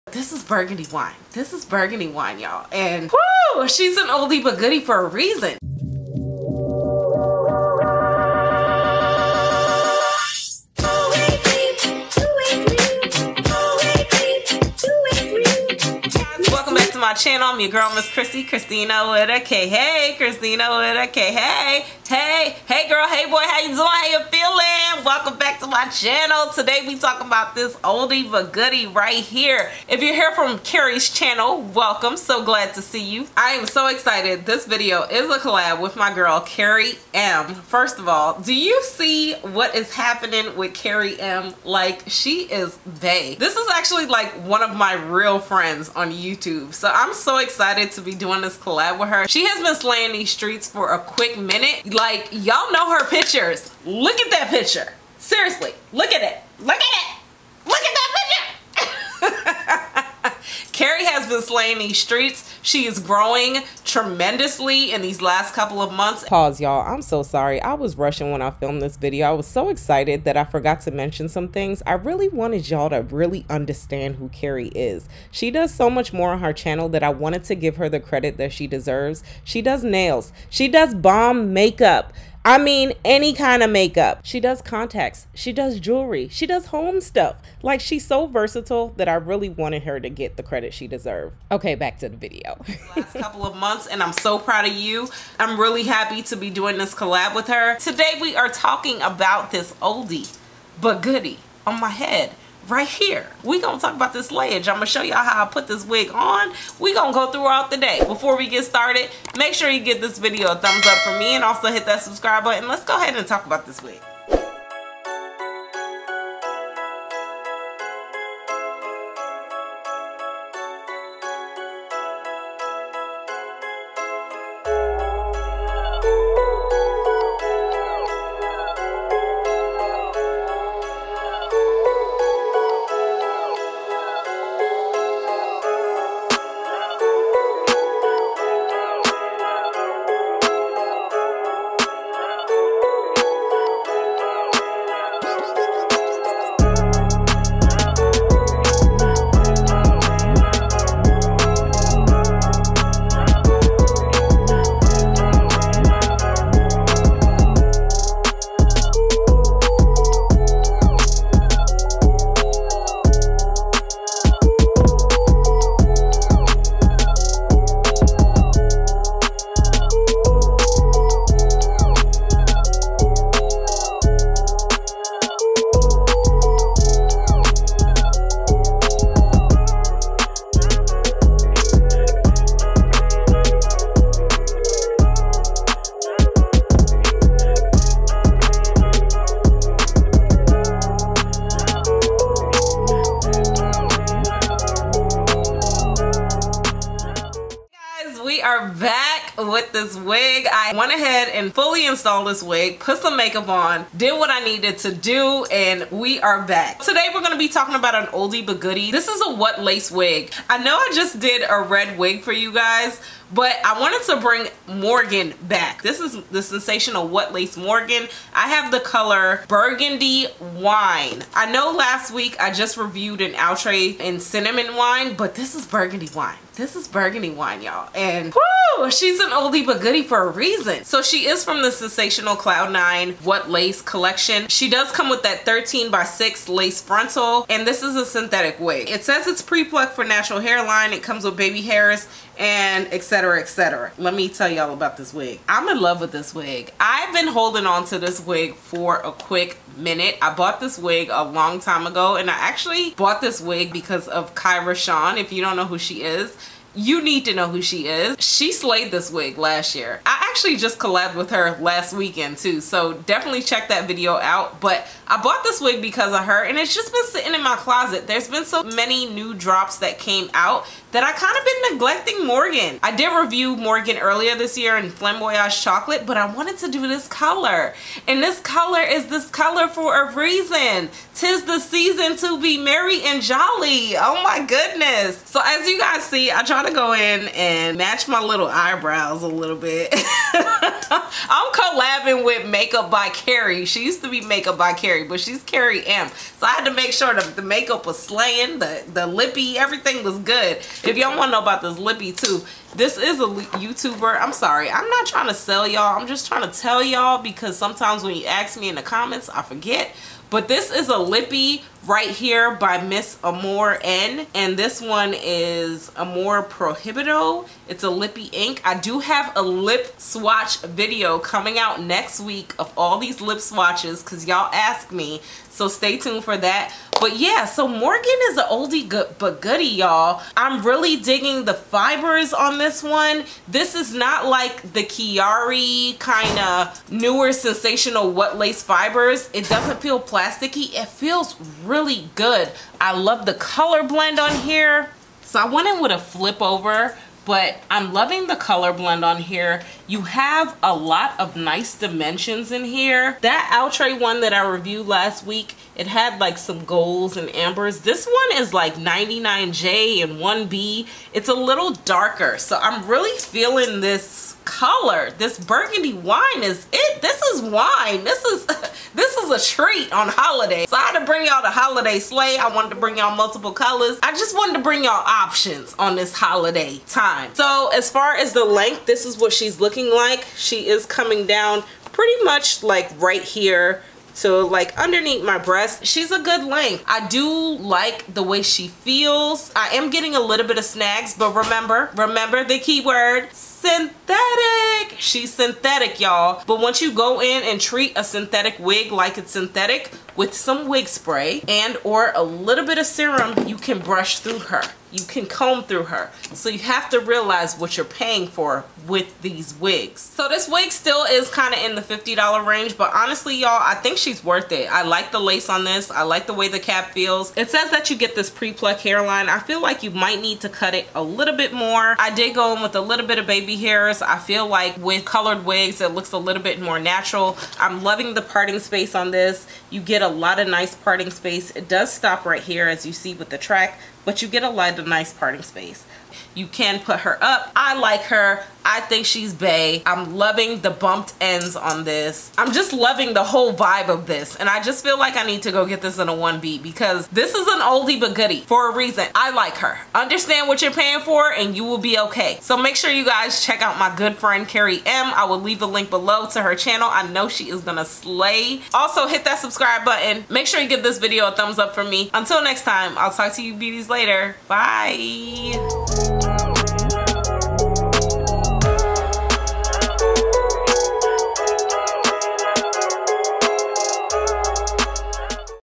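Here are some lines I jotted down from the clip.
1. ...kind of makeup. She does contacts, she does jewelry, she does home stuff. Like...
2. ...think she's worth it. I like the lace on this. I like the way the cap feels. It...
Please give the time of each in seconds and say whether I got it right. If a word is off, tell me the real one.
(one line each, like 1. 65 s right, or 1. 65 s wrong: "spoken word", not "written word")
1. 83 s right
2. 413 s right.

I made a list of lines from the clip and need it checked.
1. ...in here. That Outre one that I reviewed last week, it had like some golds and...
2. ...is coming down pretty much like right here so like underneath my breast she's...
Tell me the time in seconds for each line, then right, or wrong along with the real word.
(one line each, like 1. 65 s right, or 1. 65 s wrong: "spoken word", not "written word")
1. 352 s right
2. 380 s right.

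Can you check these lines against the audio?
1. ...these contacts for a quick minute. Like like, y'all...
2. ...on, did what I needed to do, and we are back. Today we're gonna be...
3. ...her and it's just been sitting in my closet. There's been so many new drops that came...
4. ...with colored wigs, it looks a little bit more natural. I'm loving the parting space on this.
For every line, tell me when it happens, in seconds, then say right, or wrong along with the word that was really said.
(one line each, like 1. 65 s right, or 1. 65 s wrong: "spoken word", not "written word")
1. 50 s wrong: "streets", not "contacts"
2. 203 s right
3. 266 s right
4. 424 s right.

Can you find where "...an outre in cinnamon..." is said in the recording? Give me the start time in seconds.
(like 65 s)
223 s.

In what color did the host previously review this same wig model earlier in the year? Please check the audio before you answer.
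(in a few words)
Flamboyage Chocolate.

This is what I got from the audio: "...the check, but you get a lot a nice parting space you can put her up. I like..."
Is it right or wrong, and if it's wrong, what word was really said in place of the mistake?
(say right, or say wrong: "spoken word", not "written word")
wrong: "track", not "check".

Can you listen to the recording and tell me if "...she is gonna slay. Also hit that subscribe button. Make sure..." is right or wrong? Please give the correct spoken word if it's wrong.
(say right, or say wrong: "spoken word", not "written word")
right.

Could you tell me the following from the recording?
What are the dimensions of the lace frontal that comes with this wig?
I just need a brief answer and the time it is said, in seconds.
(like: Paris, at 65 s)
13 by 6, at 235 s.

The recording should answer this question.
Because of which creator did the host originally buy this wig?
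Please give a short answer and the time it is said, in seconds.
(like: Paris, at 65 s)
Kyra Sean, at 254 s.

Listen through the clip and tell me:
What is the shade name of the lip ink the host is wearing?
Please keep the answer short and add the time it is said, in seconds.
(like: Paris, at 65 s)
Amore Prohibido, at 315 s.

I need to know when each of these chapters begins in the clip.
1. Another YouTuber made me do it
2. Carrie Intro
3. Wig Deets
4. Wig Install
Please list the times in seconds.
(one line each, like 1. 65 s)
1. 250 s
2. 30 s
3. 198 s
4. 114 s.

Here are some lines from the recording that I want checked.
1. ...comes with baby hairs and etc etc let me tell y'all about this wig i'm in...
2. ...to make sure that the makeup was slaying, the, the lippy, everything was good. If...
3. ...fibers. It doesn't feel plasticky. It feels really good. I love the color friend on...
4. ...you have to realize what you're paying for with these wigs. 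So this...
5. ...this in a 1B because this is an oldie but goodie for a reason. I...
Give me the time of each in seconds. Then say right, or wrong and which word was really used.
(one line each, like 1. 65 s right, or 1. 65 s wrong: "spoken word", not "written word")
1. 241 s right
2. 296 s right
3. 338 s wrong: "blend", not "friend"
4. 406 s right
5. 445 s right.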